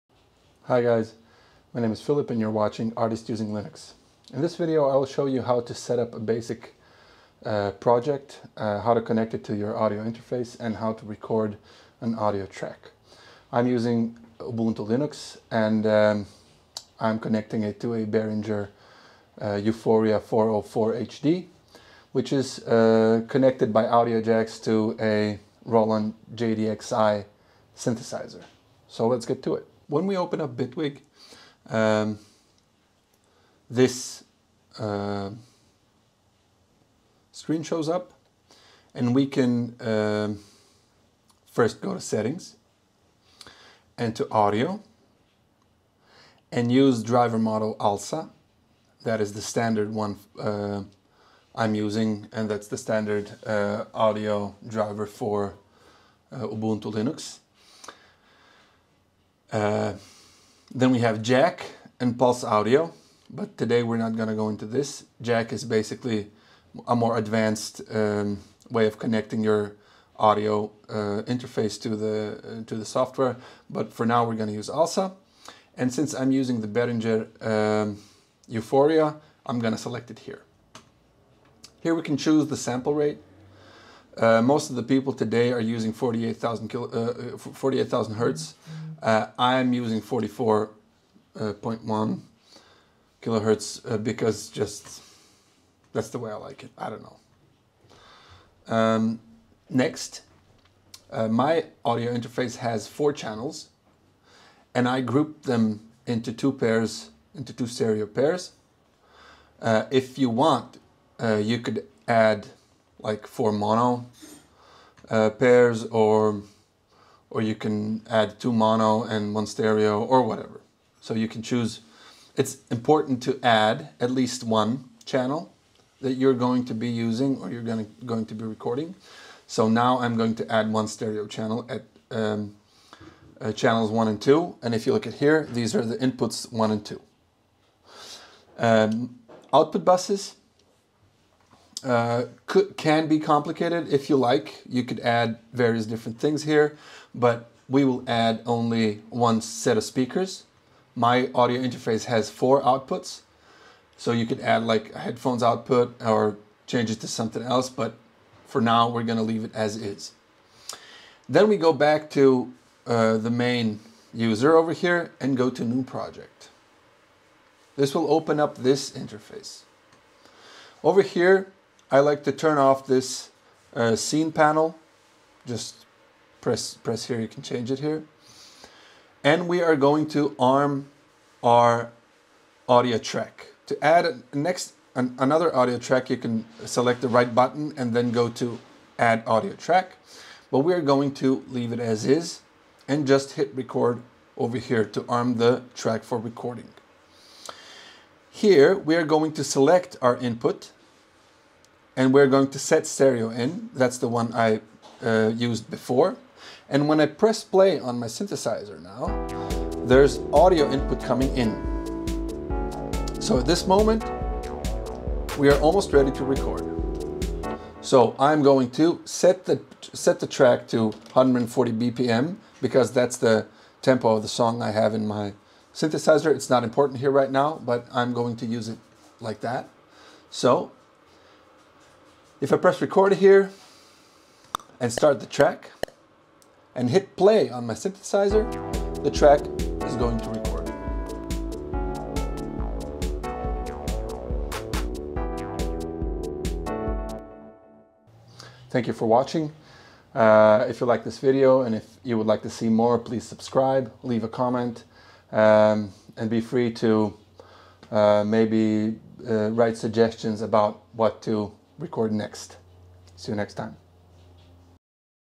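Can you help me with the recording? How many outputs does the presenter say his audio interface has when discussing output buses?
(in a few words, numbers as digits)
4.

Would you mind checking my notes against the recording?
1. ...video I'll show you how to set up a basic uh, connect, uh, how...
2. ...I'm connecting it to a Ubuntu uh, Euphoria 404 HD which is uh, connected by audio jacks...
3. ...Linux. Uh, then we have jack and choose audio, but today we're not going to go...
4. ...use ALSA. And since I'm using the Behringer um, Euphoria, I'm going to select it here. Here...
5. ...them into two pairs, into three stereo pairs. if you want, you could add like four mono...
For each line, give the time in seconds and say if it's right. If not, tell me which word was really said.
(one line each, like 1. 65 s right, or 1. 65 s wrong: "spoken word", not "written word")
1. 4 s wrong: "project", not "connect"
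2. 16 s wrong: "Behringer", not "Ubuntu"
3. 56 s wrong: "pulse", not "choose"
4. 74 s right
5. 105 s wrong: "two", not "three".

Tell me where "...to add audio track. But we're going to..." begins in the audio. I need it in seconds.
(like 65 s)
188 s.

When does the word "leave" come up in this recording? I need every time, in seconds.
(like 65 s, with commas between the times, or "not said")
159 s, 191 s, 254 s.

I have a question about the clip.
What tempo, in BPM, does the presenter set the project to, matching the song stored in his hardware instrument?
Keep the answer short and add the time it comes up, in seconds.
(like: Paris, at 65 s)
140, at 221 s.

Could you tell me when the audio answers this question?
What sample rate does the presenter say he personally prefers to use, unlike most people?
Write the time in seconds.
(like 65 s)
90 s.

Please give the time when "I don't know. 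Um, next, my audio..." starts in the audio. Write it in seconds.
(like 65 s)
96 s.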